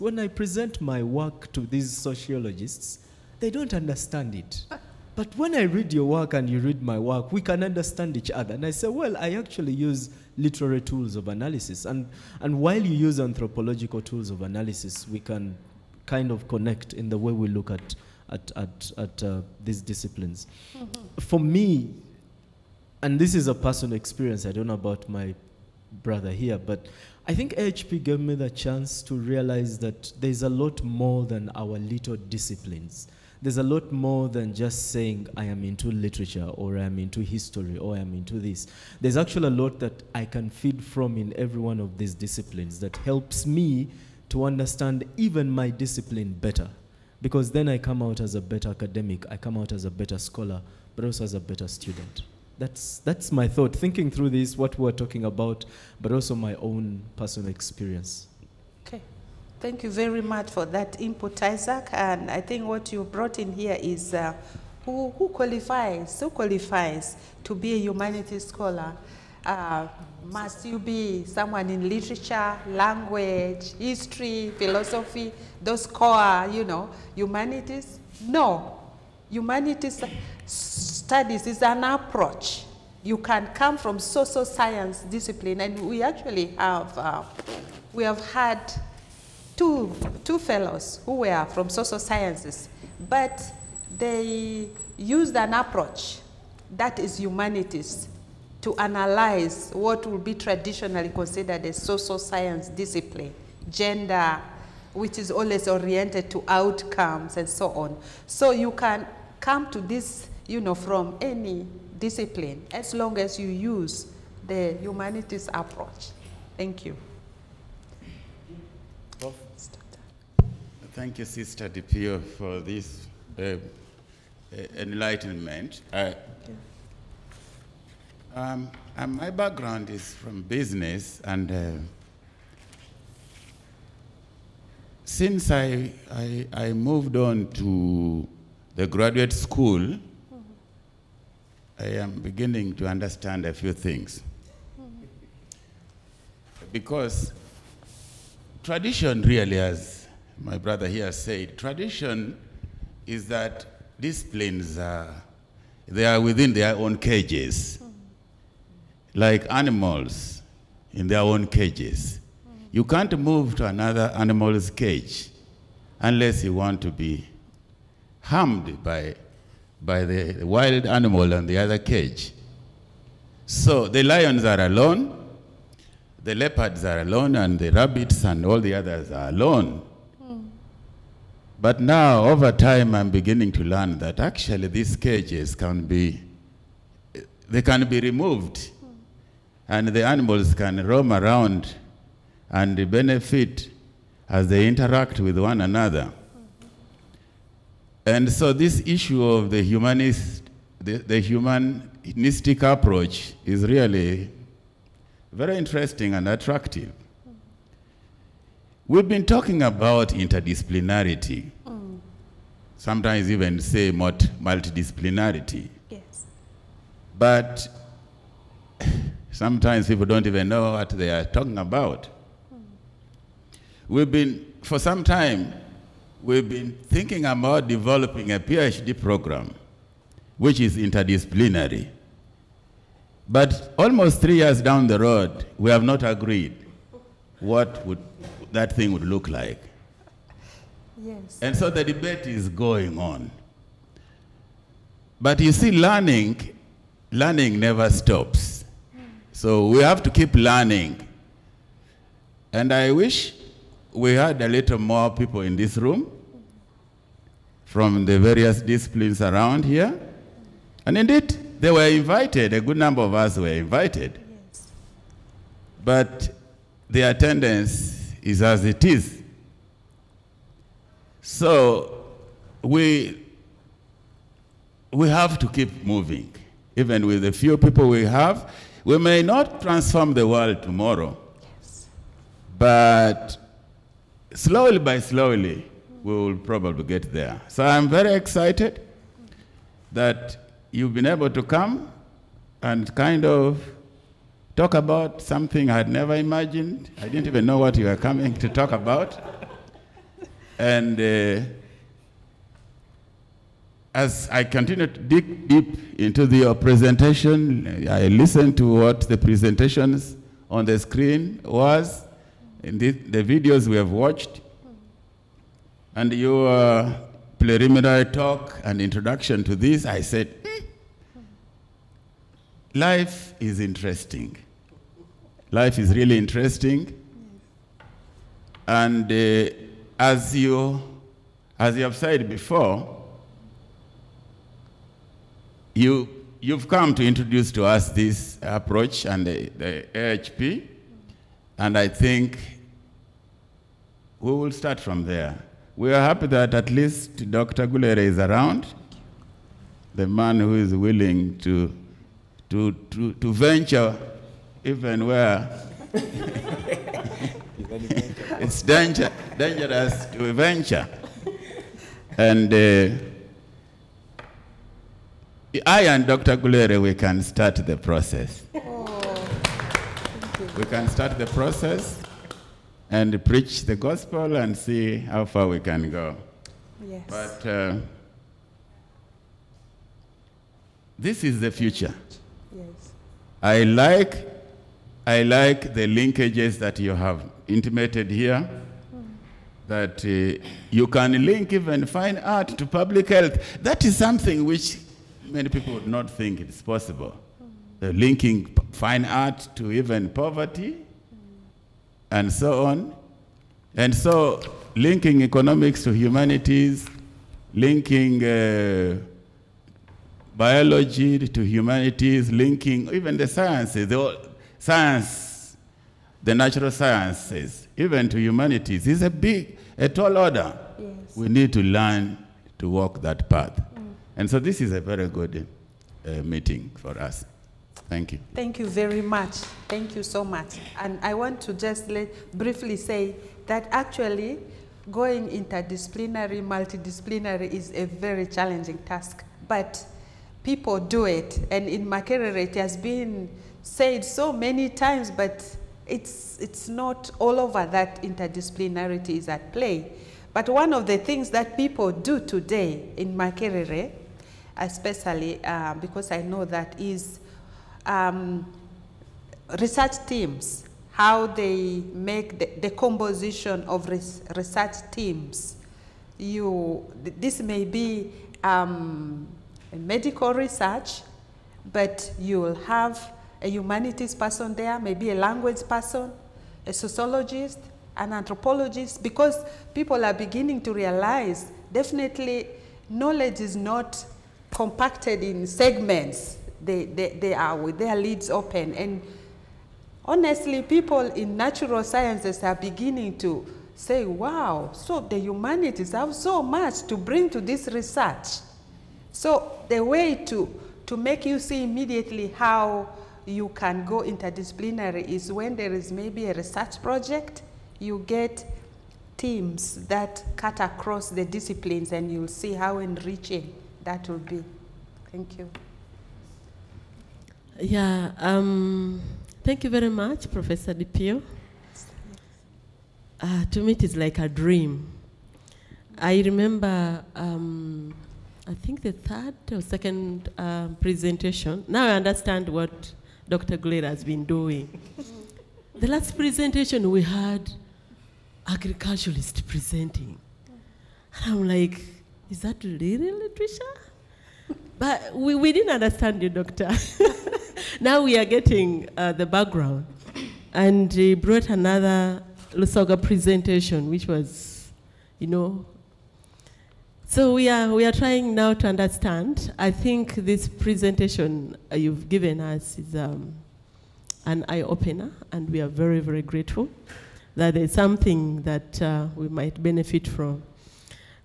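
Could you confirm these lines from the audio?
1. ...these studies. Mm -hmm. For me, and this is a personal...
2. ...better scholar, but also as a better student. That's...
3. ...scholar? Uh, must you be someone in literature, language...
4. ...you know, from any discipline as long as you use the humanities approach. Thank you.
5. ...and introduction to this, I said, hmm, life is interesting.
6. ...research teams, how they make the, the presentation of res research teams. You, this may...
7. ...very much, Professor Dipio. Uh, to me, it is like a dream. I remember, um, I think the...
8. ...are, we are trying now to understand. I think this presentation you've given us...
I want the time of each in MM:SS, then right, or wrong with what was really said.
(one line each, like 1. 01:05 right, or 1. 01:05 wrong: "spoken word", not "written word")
1. 00:19 wrong: "disciplines", not "studies"
2. 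00:49 right
3. 01:08 right
4. 01:50 right
5. 05:18 right
6. 07:39 wrong: "composition", not "presentation"
7. 08:39 right
8. 09:17 right.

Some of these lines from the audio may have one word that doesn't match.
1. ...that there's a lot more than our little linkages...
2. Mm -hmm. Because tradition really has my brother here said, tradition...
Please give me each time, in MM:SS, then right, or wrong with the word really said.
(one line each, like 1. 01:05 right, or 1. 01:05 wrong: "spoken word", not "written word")
1. 00:29 wrong: "disciplines", not "linkages"
2. 02:24 right.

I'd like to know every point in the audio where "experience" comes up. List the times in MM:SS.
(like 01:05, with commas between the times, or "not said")
00:23, 00:57.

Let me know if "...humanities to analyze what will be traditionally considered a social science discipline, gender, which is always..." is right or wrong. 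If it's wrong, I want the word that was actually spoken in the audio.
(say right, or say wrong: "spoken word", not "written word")
right.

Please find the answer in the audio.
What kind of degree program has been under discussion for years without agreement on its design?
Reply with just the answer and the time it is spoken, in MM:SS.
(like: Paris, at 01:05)
PhD program, at 03:48.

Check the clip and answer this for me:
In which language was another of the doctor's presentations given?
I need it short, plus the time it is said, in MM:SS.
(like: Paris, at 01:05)
Lusoga, at 09:12.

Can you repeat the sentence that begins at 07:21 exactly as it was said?
And in Makerere, it has been said so many times, but it's, it's not all over that interdisciplinarity is at play.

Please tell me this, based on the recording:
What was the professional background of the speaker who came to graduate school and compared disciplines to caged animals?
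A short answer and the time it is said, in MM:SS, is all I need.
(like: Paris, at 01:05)
business, at 02:10.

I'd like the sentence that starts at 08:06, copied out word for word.
They, they, they are with their lids open.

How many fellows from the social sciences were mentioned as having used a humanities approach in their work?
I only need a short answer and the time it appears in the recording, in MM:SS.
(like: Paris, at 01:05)
2, at 01:30.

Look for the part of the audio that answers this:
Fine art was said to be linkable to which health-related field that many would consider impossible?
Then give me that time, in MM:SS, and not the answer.
06:32.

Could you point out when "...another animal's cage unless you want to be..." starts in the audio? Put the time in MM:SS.
02:43.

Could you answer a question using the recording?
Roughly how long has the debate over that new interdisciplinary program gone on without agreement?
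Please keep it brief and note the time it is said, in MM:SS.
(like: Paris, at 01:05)
almost three years, at 03:53.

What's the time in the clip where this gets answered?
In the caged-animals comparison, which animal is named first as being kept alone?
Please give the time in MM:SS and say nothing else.
02:54.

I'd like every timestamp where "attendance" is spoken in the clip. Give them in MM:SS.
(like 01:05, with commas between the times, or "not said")
04:27.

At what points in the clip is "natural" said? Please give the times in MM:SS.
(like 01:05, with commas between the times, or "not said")
06:56, 08:11.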